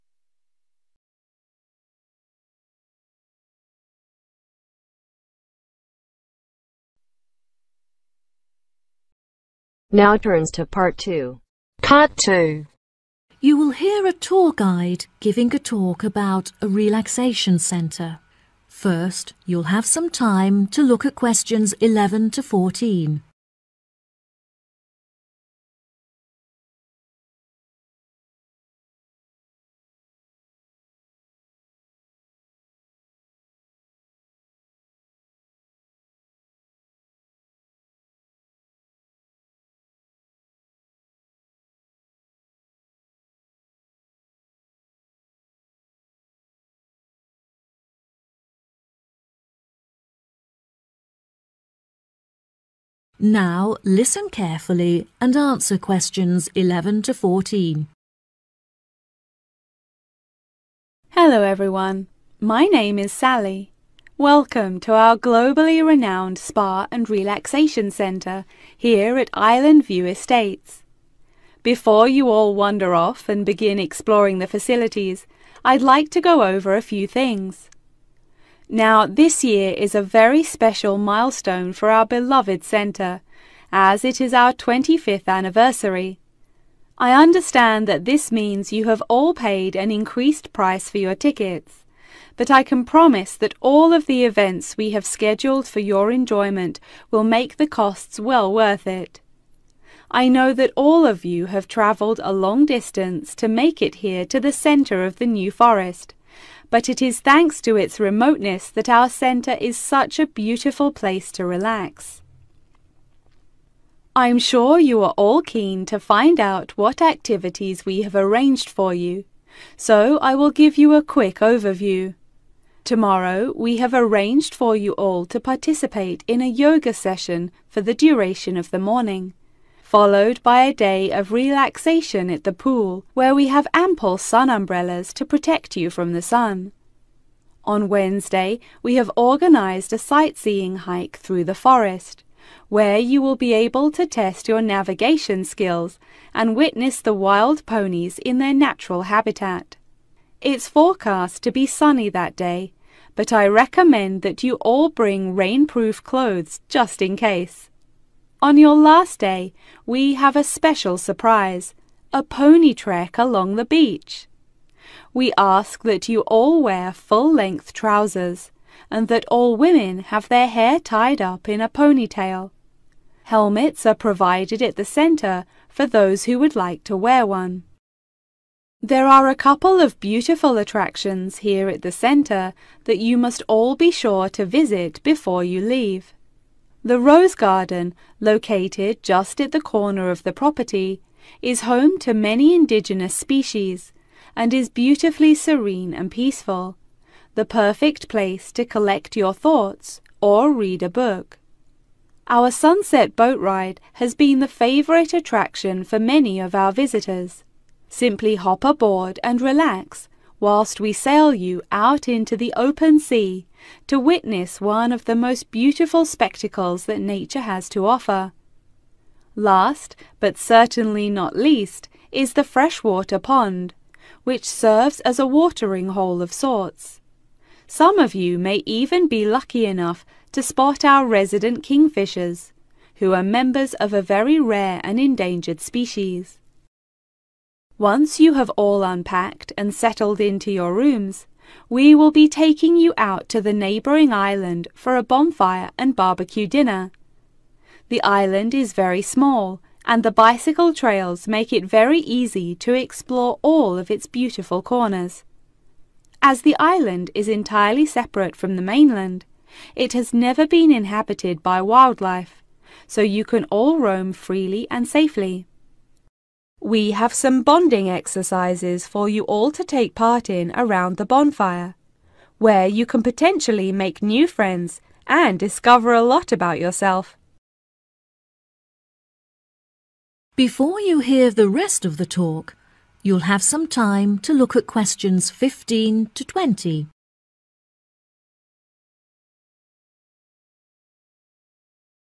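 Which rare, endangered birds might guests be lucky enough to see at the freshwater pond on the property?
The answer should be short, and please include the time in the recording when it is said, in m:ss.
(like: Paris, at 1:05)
kingfishers, at 3:51.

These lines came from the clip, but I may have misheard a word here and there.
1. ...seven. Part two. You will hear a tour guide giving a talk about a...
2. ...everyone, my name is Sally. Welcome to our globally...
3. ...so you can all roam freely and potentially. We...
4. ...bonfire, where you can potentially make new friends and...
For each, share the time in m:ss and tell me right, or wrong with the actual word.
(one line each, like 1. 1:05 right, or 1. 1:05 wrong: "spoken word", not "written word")
1. 0:10 wrong: "two", not "seven"
2. 1:01 right
3. 4:22 wrong: "safely", not "potentially"
4. 4:31 right.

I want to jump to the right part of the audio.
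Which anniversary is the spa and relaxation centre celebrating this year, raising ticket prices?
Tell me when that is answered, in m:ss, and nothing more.
1:24.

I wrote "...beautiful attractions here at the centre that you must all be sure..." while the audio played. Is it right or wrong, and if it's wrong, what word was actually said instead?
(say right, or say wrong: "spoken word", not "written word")
right.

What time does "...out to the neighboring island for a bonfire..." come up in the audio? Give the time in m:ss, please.
4:02.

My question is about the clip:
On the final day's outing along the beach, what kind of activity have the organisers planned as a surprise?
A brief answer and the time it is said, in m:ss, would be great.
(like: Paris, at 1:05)
pony trek, at 2:42.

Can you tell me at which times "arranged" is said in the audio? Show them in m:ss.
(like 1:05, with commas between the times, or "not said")
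1:58, 2:03.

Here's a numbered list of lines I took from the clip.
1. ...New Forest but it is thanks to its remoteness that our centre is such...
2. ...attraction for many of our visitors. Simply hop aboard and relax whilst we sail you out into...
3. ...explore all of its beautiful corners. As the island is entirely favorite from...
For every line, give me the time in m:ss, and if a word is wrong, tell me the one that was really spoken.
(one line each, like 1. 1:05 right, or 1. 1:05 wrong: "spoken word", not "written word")
1. 1:45 right
2. 3:25 right
3. 4:12 wrong: "separate", not "favorite".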